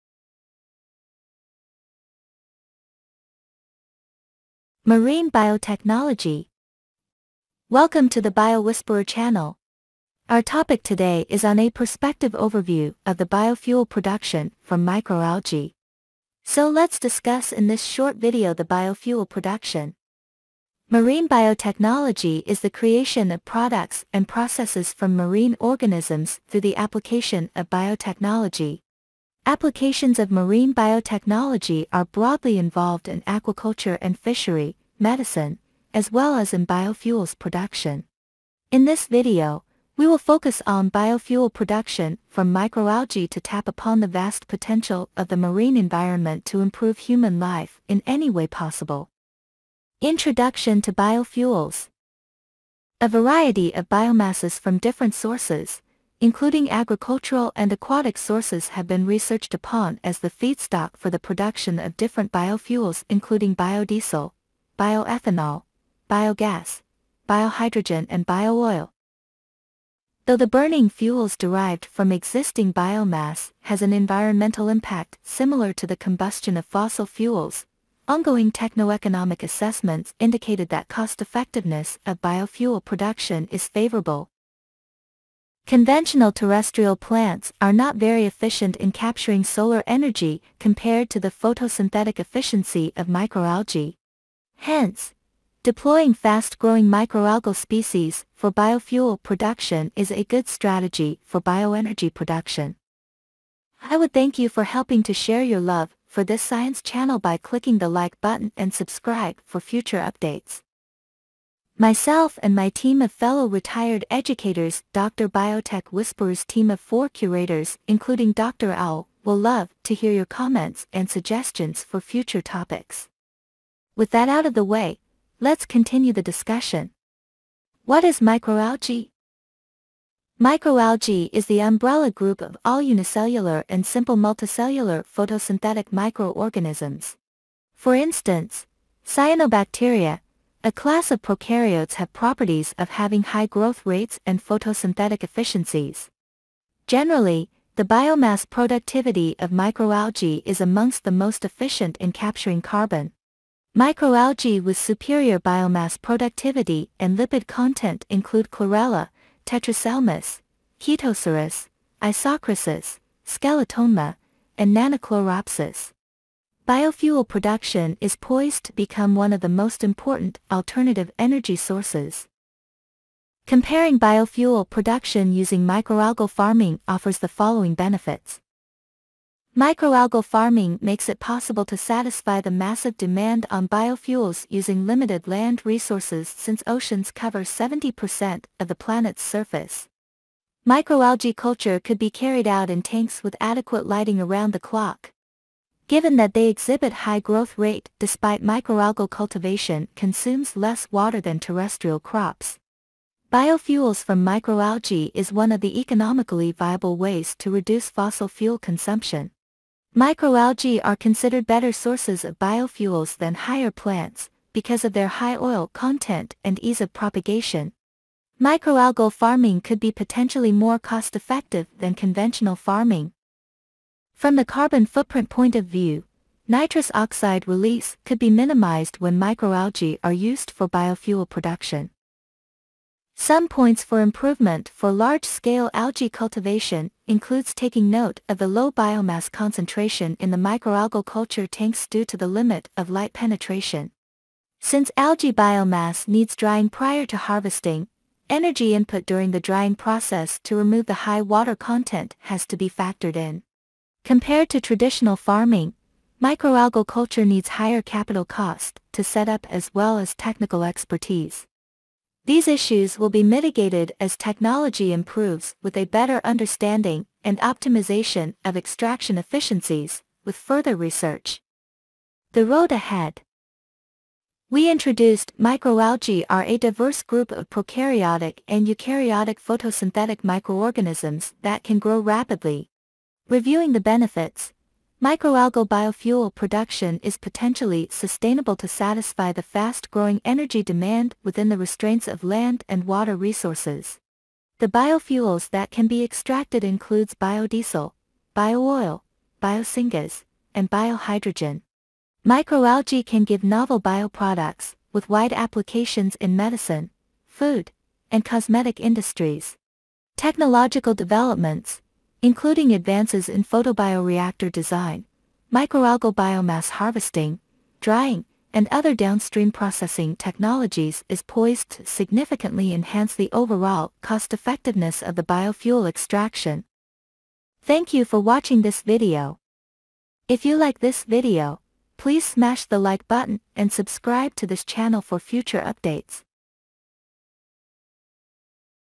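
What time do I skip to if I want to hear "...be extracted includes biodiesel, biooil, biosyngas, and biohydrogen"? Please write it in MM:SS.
04:55.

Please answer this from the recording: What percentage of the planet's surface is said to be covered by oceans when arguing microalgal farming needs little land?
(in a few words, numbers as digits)
70%.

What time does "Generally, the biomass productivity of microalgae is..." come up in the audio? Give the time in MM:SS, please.
02:26.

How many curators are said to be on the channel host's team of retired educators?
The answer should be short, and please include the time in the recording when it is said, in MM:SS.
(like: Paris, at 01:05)
4, at 01:56.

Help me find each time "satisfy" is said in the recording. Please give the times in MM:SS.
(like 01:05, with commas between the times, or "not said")
03:01, 04:48.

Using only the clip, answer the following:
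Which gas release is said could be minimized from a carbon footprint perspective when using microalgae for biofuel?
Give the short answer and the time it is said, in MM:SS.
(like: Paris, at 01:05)
Nitrous oxide, at 03:46.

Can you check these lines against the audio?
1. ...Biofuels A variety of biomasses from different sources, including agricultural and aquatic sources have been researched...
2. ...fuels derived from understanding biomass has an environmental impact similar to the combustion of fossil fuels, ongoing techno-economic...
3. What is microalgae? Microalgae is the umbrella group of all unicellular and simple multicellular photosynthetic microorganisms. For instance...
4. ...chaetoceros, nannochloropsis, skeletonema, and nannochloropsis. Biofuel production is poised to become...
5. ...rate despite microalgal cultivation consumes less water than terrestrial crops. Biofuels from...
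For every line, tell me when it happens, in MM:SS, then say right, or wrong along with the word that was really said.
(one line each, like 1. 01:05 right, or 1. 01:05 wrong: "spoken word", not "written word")
1. 00:50 right
2. 01:10 wrong: "existing", not "understanding"
3. 02:07 right
4. 02:40 wrong: "isochrysis", not "nannochloropsis"
5. 03:17 right.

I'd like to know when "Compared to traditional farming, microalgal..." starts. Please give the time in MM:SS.
04:14.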